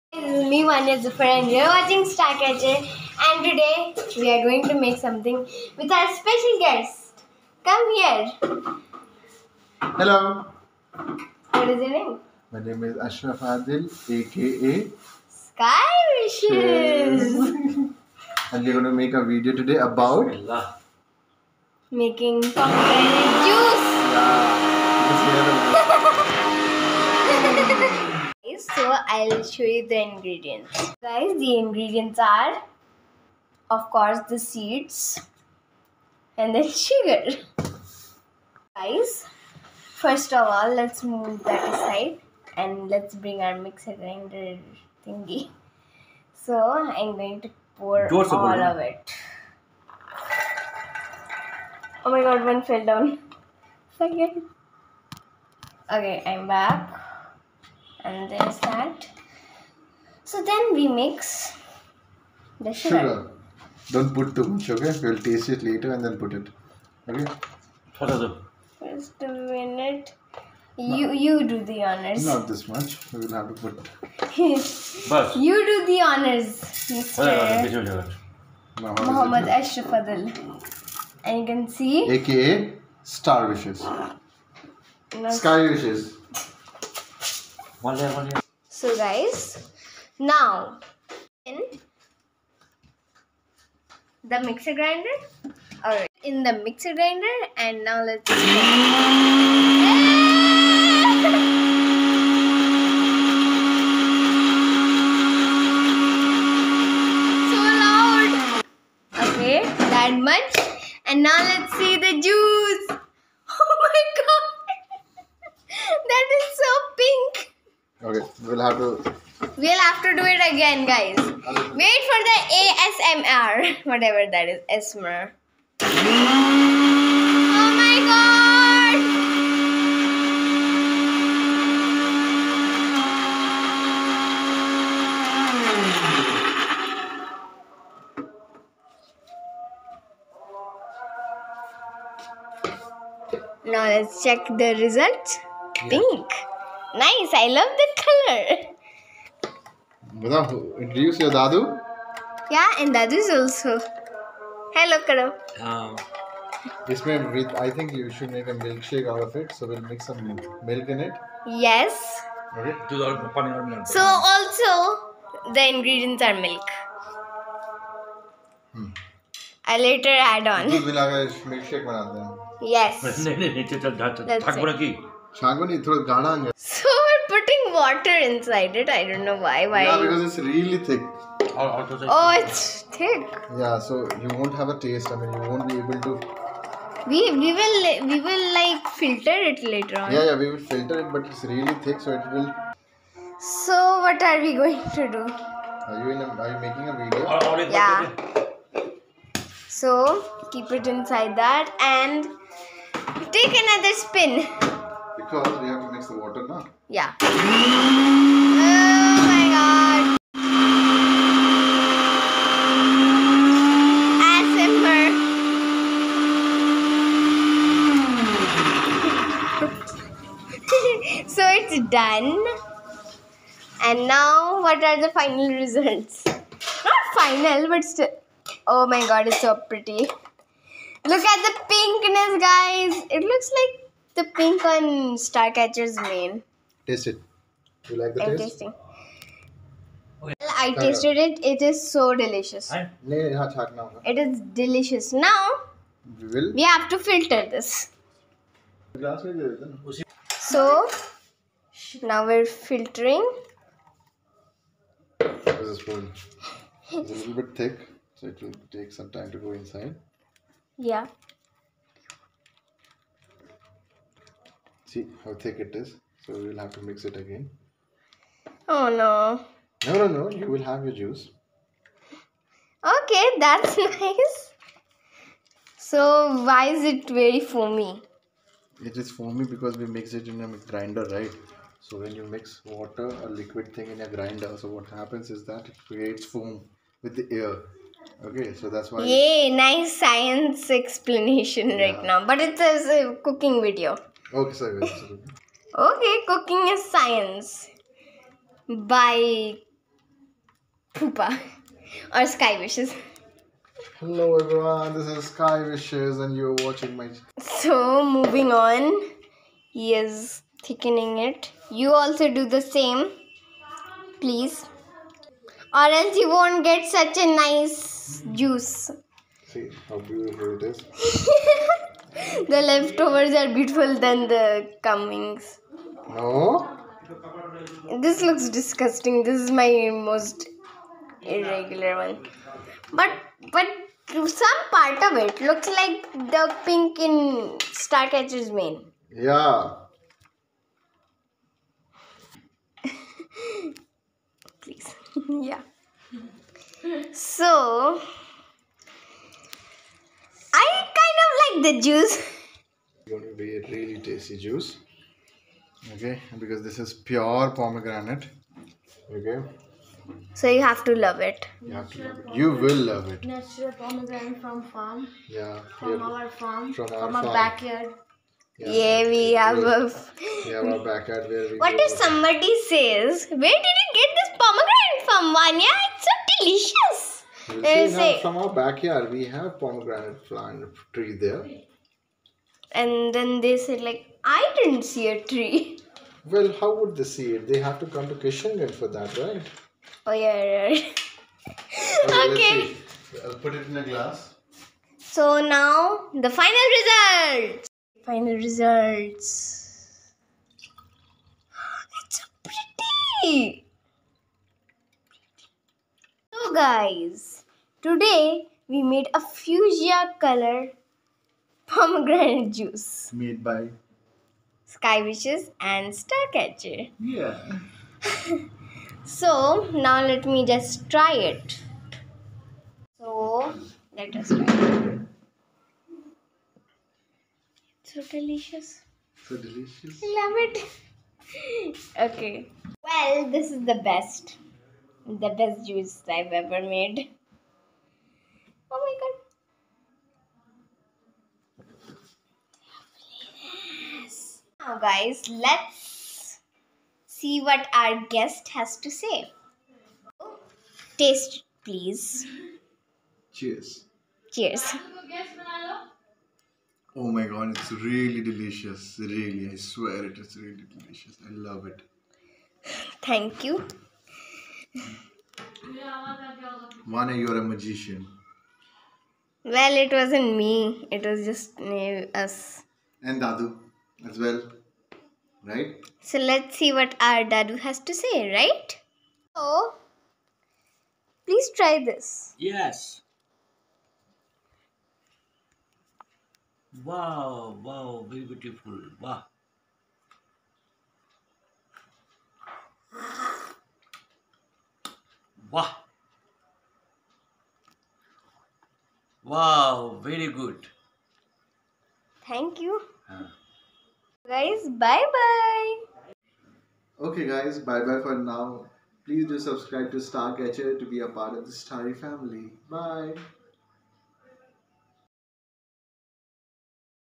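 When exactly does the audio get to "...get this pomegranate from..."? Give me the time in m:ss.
6:13.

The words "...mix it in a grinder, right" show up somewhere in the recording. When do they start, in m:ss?
4:39.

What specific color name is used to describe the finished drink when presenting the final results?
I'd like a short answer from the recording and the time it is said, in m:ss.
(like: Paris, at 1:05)
fuchsia, at 6:49.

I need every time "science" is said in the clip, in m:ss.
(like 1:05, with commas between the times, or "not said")
4:49, 4:56.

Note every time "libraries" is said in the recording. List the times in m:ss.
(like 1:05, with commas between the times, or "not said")
not said.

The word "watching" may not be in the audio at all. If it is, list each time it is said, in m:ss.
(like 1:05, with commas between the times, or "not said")
0:01, 5:06.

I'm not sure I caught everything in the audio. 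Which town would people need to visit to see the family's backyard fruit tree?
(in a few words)
Kishanganj.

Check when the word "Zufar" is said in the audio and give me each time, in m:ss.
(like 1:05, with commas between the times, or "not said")
0:01.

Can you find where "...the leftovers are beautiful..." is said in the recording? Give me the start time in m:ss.
5:22.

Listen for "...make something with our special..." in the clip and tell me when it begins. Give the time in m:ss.
0:04.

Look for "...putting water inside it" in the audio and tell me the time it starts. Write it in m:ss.
2:57.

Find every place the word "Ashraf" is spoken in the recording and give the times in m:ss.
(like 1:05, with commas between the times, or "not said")
0:13, 1:19.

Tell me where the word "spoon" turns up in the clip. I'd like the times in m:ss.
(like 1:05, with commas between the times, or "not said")
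4:15.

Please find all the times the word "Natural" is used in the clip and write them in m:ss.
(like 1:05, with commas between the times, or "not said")
6:03.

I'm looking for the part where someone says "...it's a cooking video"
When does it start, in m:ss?
4:52.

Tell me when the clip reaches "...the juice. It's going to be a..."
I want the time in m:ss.
5:51.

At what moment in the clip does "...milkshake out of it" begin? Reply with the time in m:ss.
2:38.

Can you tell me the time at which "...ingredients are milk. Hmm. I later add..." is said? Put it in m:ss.
2:45.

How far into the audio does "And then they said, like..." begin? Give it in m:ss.
6:22.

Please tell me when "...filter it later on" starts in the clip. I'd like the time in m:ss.
3:08.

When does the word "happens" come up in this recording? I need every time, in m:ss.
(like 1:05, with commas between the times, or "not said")
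4:44.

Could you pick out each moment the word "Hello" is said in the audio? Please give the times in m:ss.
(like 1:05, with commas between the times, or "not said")
0:10, 2:34, 5:03, 6:46.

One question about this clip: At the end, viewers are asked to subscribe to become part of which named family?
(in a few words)
Starry family.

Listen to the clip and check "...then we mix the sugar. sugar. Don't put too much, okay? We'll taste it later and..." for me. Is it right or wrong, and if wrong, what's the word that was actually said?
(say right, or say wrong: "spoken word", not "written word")
right.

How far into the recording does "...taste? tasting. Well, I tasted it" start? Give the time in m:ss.
3:58.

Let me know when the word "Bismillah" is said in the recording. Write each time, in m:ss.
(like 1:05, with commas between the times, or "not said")
0:20.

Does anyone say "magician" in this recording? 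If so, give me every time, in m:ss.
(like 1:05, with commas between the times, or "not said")
7:47.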